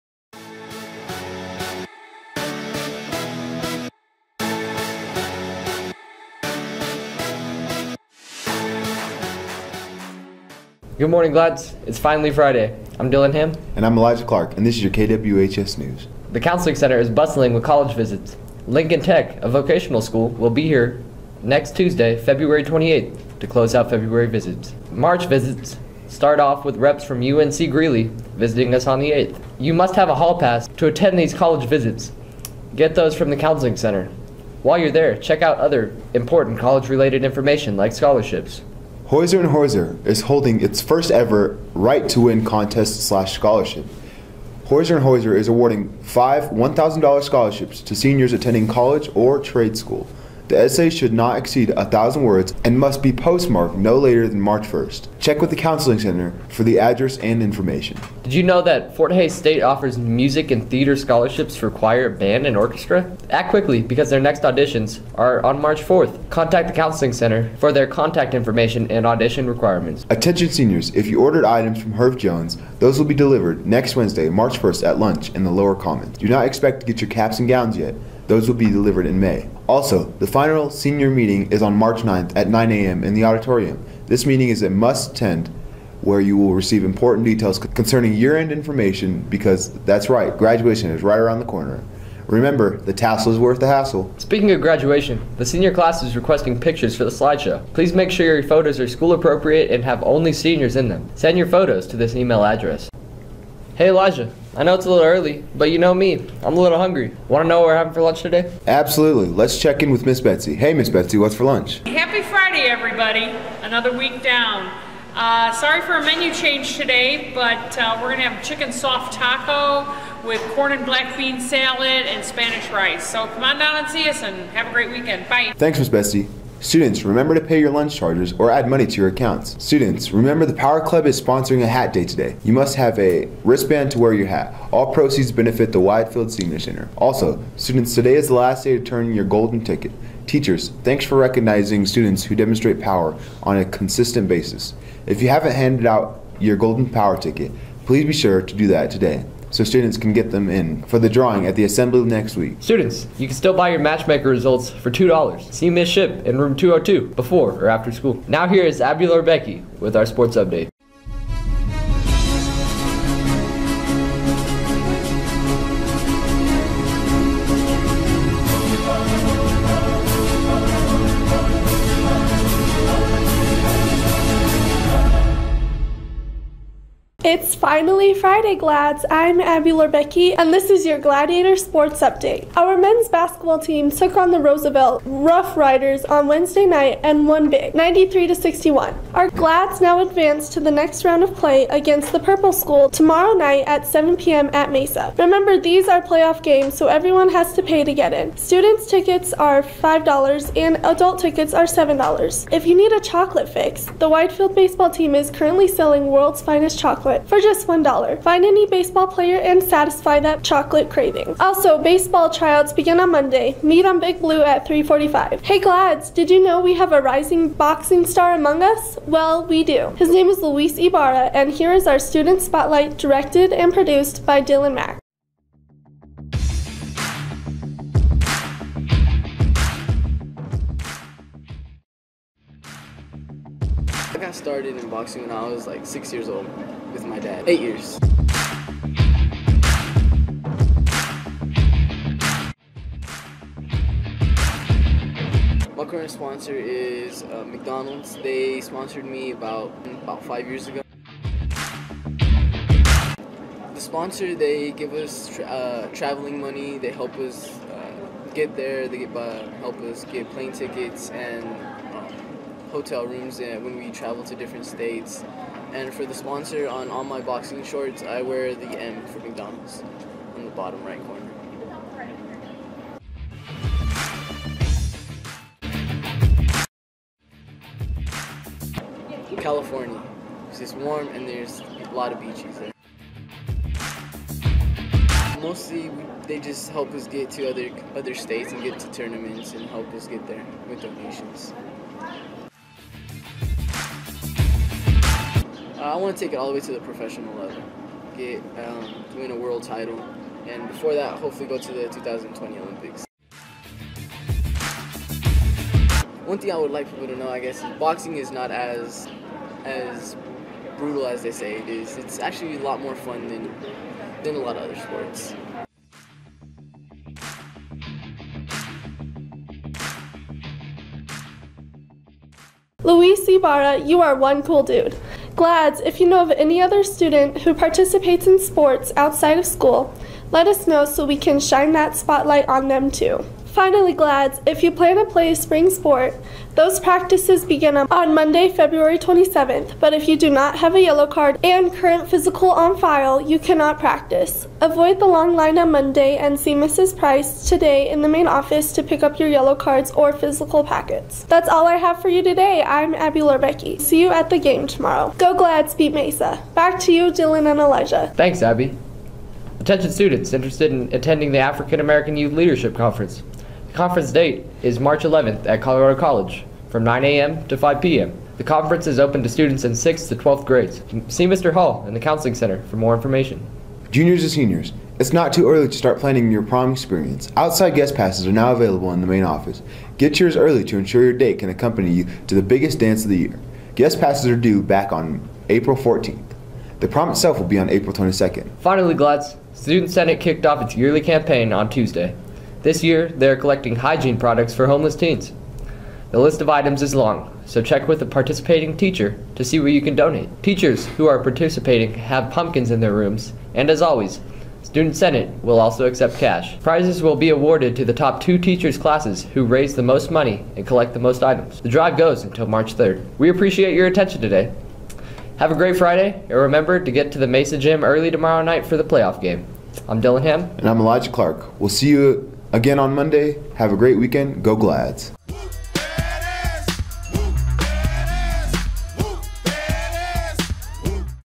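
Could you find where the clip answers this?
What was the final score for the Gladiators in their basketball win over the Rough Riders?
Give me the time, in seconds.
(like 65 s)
187 s.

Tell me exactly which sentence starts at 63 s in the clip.
Act quickly because their next auditions are on March 4th.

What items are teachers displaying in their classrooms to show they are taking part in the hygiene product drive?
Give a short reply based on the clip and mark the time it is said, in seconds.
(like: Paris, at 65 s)
Pumpkins, at 402 s.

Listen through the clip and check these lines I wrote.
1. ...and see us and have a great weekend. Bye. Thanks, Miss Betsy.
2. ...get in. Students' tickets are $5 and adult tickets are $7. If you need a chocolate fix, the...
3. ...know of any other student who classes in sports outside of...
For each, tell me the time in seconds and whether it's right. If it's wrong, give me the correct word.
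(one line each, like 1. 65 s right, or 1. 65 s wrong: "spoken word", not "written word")
1. 123 s right
2. 197 s right
3. 326 s wrong: "participates", not "classes".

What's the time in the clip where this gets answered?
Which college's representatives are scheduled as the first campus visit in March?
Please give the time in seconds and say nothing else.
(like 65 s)
27 s.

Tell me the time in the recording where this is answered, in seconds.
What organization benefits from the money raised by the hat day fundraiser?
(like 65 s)
135 s.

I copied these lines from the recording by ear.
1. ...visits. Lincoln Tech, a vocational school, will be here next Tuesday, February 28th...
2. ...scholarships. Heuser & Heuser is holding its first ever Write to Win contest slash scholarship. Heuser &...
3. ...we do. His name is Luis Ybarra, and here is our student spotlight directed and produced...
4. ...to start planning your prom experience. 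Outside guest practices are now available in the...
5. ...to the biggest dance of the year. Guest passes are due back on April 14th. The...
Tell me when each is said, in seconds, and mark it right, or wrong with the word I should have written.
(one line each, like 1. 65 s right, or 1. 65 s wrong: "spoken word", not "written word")
1. 17 s right
2. 37 s right
3. 219 s right
4. 375 s wrong: "passes", not "practices"
5. 382 s right.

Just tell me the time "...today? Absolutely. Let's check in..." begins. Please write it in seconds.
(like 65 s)
108 s.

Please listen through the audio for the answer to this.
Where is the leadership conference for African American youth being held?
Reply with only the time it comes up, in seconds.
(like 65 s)
365 s.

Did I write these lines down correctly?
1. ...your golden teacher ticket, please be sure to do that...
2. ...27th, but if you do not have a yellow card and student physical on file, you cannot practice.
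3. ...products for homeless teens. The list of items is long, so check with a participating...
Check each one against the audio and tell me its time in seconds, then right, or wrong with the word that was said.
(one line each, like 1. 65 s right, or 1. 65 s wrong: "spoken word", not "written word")
1. 146 s wrong: "power", not "teacher"
2. 338 s wrong: "current", not "student"
3. 394 s right.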